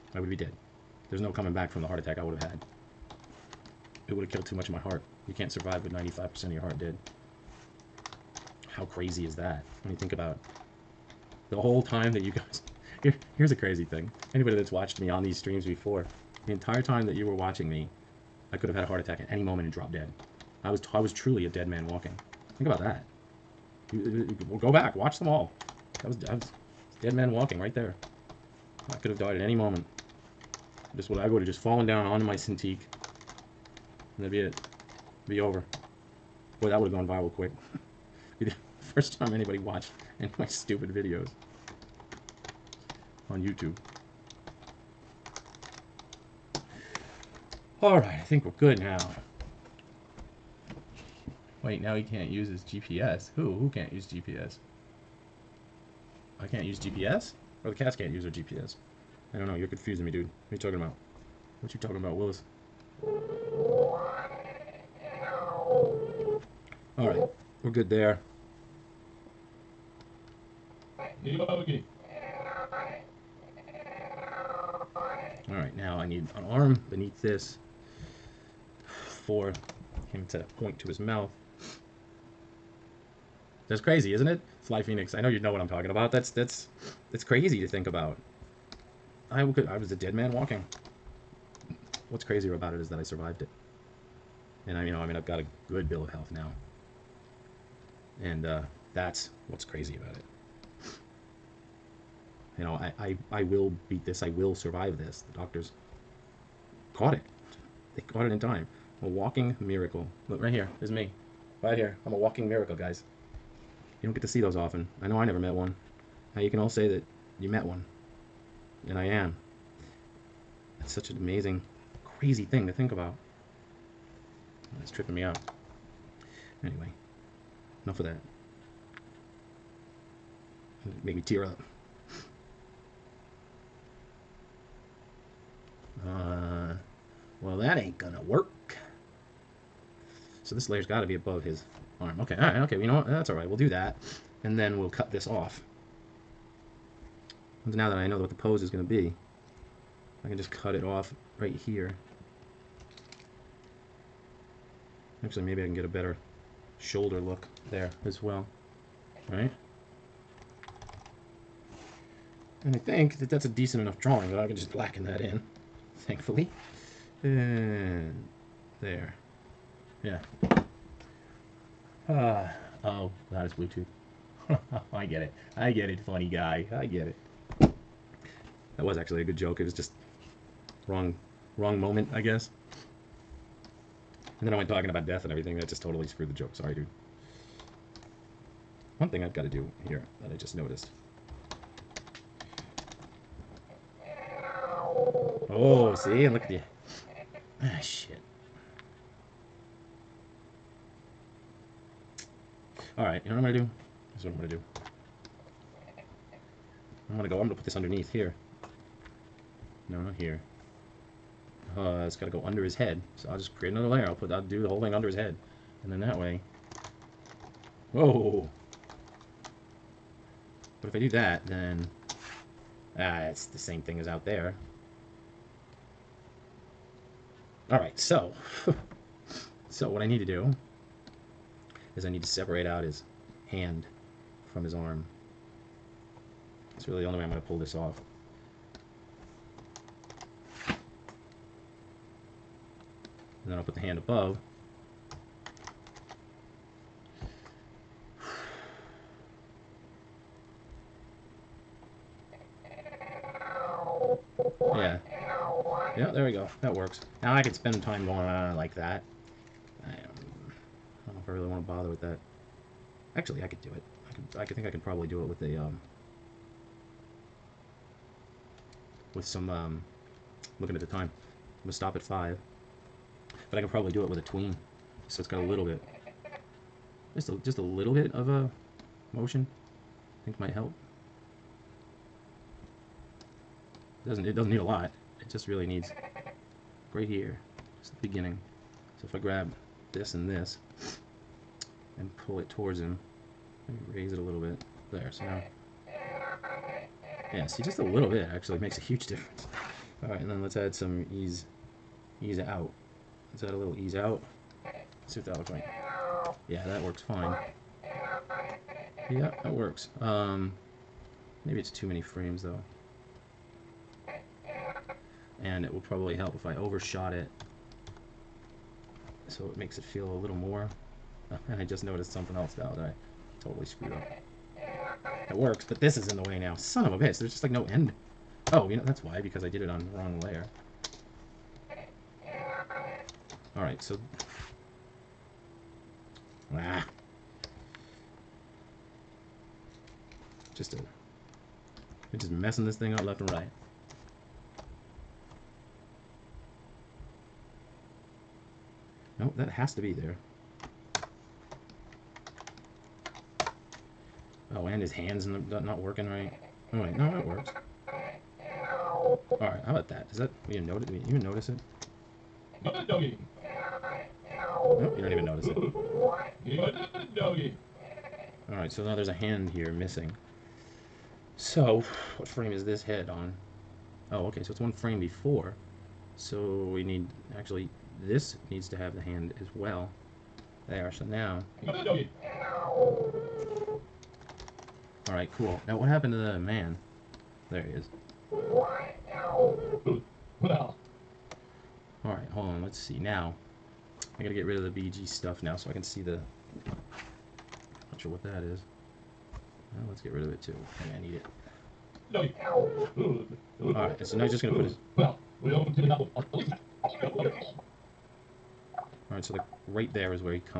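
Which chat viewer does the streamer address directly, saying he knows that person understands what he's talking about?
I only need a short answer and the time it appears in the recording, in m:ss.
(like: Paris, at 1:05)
Fly Phoenix, at 1:24.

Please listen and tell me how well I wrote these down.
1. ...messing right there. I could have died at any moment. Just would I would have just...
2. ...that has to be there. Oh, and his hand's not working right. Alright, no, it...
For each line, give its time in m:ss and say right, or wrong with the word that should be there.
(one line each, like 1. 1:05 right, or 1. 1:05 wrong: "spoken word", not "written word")
1. 0:27 wrong: "walking", not "messing"
2. 5:49 right.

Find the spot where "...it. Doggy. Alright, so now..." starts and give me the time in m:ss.
6:05.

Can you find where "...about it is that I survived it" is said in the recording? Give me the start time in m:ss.
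1:32.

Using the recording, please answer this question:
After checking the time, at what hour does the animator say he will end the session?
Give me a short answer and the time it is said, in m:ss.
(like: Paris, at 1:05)
5, at 4:32.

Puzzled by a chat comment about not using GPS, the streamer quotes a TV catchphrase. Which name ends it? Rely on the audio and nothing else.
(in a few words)
Willis.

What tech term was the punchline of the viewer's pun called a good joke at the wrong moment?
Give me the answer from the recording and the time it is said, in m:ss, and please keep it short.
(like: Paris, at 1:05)
Bluetooth, at 2:53.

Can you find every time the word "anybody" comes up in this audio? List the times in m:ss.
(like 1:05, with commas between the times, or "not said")
0:14, 0:39.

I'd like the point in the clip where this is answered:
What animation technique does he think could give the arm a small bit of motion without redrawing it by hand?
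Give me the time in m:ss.
4:34.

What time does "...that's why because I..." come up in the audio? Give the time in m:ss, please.
5:28.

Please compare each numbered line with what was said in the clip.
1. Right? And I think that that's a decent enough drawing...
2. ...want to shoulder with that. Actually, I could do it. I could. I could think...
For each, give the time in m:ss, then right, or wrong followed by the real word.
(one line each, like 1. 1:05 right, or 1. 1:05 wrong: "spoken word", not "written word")
1. 2:39 right
2. 4:21 wrong: "bother", not "shoulder".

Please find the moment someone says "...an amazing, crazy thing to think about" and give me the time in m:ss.
2:01.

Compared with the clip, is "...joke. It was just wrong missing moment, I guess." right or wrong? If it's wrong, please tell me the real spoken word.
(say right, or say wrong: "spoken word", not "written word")
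wrong: "wrong", not "missing".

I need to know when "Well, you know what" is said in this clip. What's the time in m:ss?
2:22.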